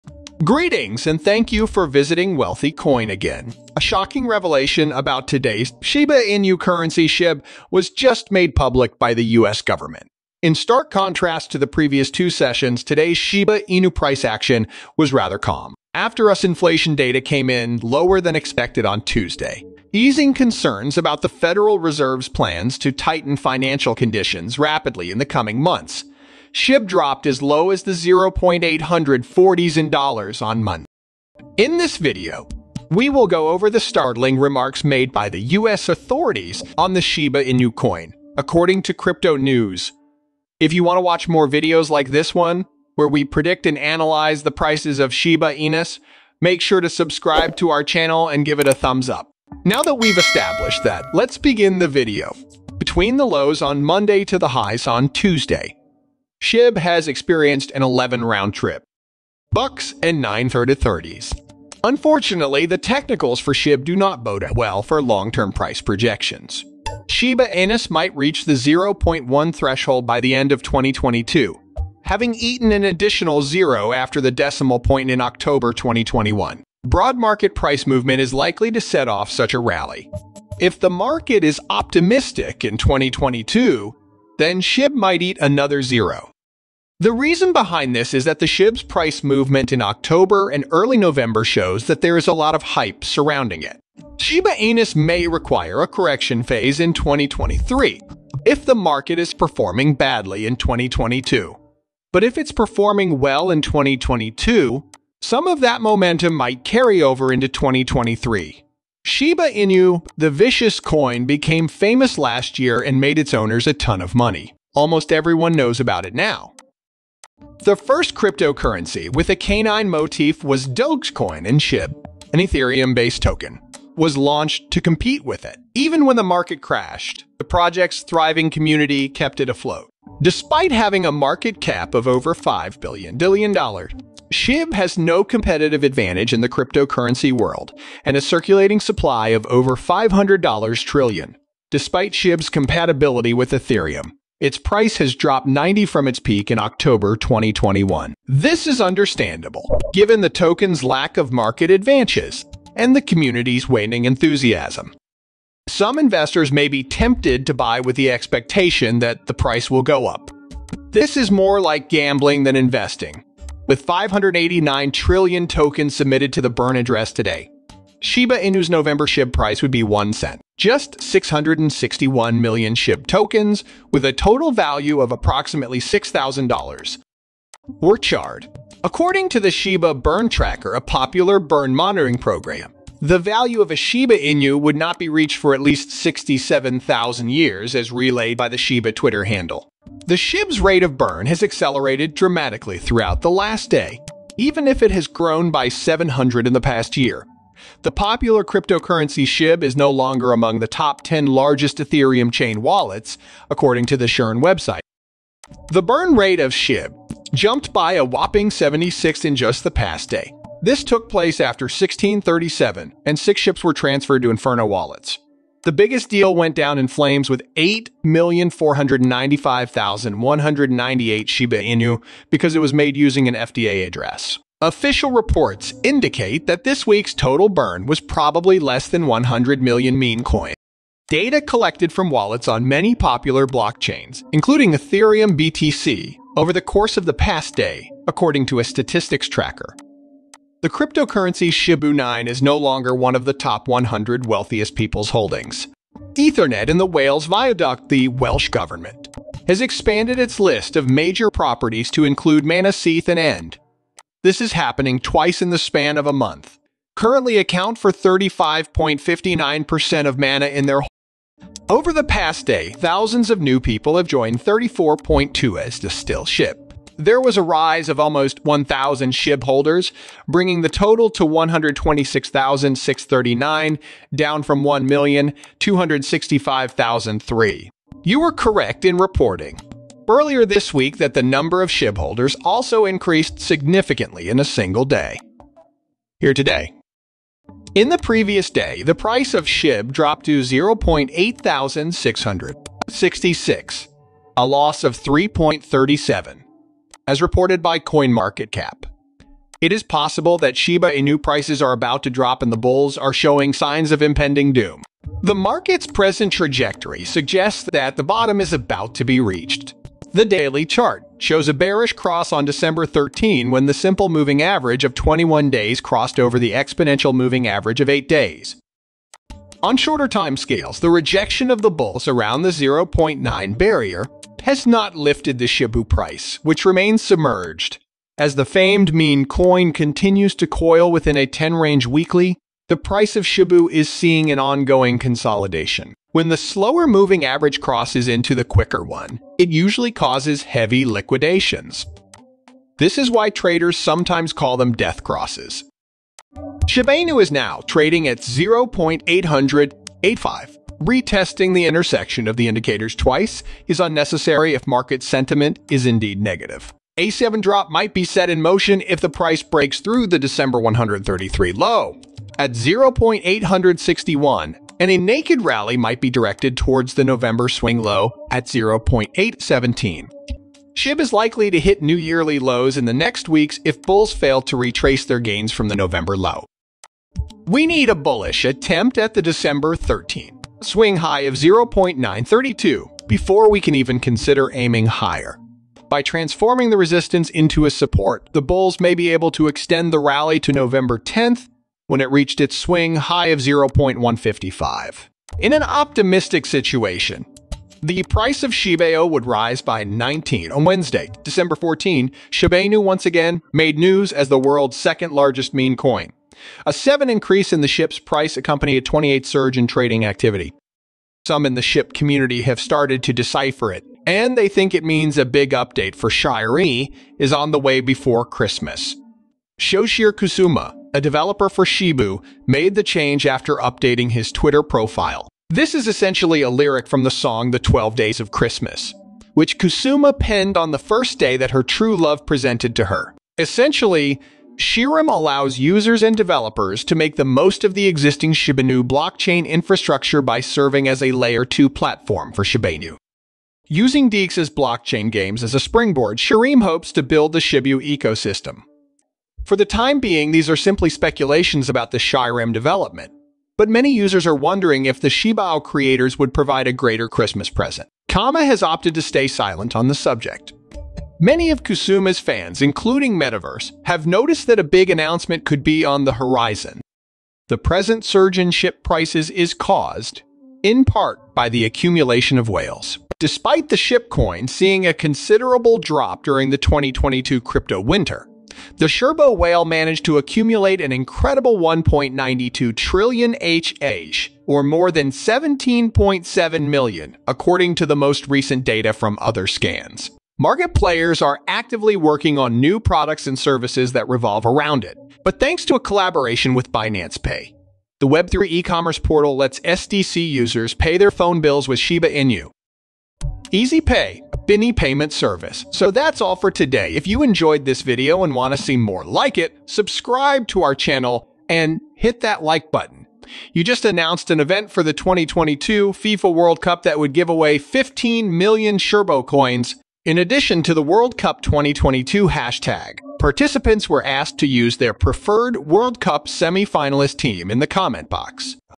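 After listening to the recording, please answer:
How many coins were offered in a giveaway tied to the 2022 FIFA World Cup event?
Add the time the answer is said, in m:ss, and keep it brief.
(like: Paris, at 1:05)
15 million, at 8:37.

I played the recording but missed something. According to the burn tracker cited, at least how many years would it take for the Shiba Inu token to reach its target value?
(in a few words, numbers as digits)
67,000.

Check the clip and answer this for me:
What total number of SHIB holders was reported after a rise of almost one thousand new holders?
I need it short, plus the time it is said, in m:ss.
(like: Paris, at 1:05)
126,639, at 4:31.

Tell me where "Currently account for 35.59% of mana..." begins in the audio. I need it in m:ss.
4:16.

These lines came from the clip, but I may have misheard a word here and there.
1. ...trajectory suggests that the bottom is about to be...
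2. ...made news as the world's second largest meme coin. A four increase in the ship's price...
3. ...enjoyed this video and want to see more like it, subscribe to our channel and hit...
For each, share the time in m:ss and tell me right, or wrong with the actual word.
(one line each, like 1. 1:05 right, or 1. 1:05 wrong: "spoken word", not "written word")
1. 5:06 right
2. 6:43 wrong: "seven", not "four"
3. 8:27 right.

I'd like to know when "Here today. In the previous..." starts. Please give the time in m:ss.
4:46.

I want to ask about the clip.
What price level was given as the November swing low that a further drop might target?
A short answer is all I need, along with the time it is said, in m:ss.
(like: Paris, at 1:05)
0.817, at 6:08.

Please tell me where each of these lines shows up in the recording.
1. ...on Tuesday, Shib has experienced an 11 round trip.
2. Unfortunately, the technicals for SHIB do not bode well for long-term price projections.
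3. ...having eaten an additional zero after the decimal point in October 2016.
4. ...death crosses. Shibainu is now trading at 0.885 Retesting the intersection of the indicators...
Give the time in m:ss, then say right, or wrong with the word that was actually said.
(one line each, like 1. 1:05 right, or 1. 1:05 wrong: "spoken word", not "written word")
1. 0:54 right
2. 1:01 right
3. 1:12 wrong: "2021", not "2016"
4. 5:44 right.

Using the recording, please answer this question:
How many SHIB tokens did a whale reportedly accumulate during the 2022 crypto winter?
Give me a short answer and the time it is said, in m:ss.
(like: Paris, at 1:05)
1.92 trillion, at 8:01.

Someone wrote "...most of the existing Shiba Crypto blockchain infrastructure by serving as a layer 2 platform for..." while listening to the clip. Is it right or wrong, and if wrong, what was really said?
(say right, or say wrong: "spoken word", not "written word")
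wrong: "Inu", not "Crypto".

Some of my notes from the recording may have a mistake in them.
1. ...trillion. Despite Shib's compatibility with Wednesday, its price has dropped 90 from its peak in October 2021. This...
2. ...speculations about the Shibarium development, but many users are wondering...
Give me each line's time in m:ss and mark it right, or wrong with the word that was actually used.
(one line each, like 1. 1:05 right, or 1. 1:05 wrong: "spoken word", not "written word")
1. 2:20 wrong: "Ethereum", not "Wednesday"
2. 7:30 right.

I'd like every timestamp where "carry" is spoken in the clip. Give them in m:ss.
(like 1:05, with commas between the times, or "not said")
1:46.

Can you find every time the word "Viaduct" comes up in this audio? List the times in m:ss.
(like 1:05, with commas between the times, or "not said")
4:07.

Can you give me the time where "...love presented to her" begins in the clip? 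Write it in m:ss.
7:11.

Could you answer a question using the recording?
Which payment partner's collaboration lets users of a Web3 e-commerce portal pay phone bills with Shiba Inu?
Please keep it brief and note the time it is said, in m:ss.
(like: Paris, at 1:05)
Binance Pay, at 8:16.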